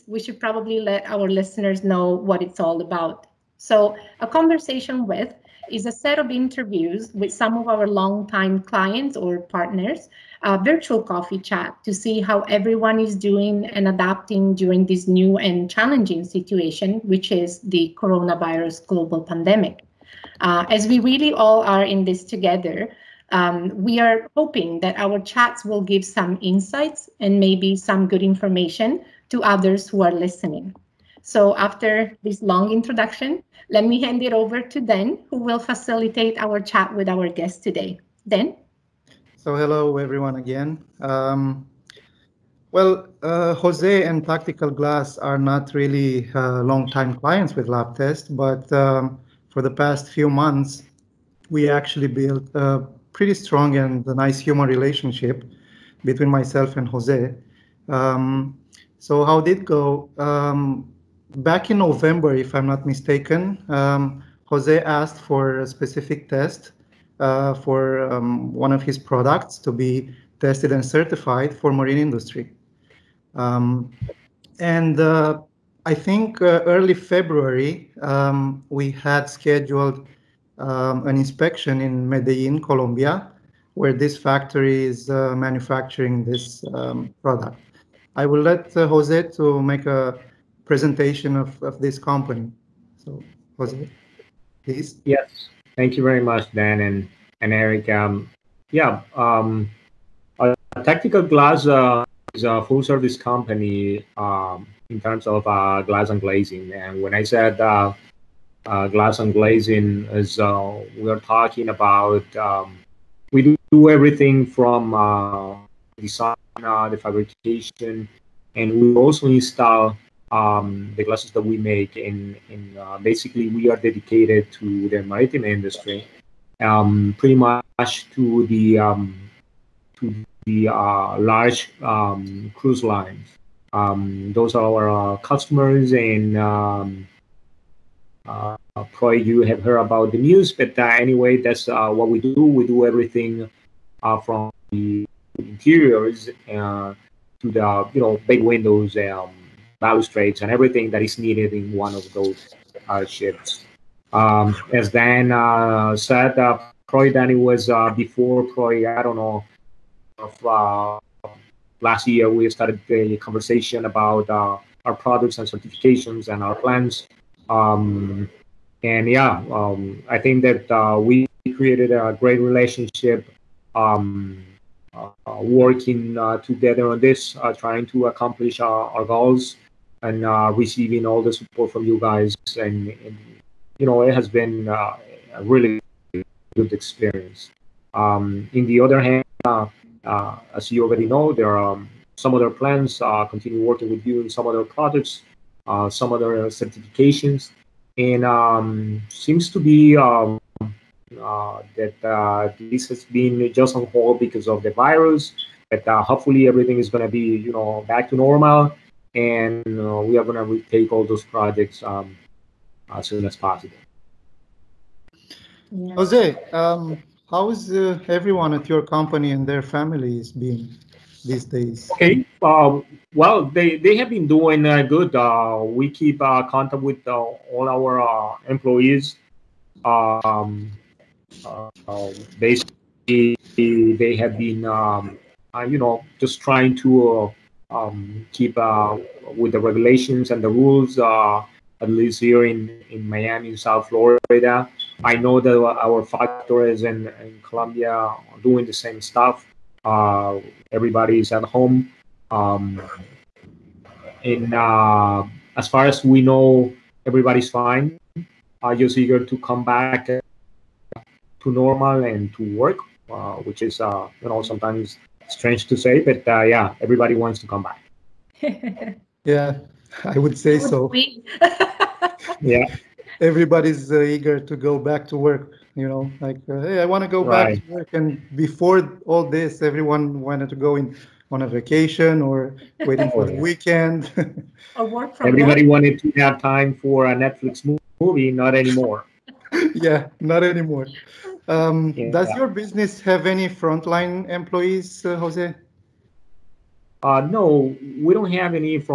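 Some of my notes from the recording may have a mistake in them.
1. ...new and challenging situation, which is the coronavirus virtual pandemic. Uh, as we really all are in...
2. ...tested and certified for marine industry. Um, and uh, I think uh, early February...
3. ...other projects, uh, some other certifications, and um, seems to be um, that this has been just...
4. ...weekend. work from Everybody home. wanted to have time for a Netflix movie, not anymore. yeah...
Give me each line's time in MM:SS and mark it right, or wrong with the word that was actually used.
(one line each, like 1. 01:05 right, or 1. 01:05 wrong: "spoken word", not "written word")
1. 00:15 wrong: "global", not "virtual"
2. 01:10 right
3. 03:14 right
4. 04:43 right.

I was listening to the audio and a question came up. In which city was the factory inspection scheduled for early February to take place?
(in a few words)
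Medellin.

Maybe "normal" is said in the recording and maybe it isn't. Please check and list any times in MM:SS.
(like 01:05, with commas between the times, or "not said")
03:28, 04:21.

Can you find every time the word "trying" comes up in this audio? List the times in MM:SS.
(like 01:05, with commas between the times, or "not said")
02:57, 03:56.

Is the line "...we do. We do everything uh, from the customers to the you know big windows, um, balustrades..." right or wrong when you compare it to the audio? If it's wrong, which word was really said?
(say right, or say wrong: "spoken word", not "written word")
wrong: "interiors", not "customers".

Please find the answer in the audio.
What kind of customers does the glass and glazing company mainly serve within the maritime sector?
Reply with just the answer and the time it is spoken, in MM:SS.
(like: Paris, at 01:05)
Cruise lines, at 02:12.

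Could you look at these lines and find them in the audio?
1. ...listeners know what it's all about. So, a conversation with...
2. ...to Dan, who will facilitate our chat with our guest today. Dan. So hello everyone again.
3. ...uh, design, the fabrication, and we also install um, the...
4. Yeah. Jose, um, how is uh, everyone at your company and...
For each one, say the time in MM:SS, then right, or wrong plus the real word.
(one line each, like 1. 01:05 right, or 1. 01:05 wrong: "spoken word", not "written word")
1. 00:01 right
2. 00:34 right
3. 01:54 right
4. 03:35 right.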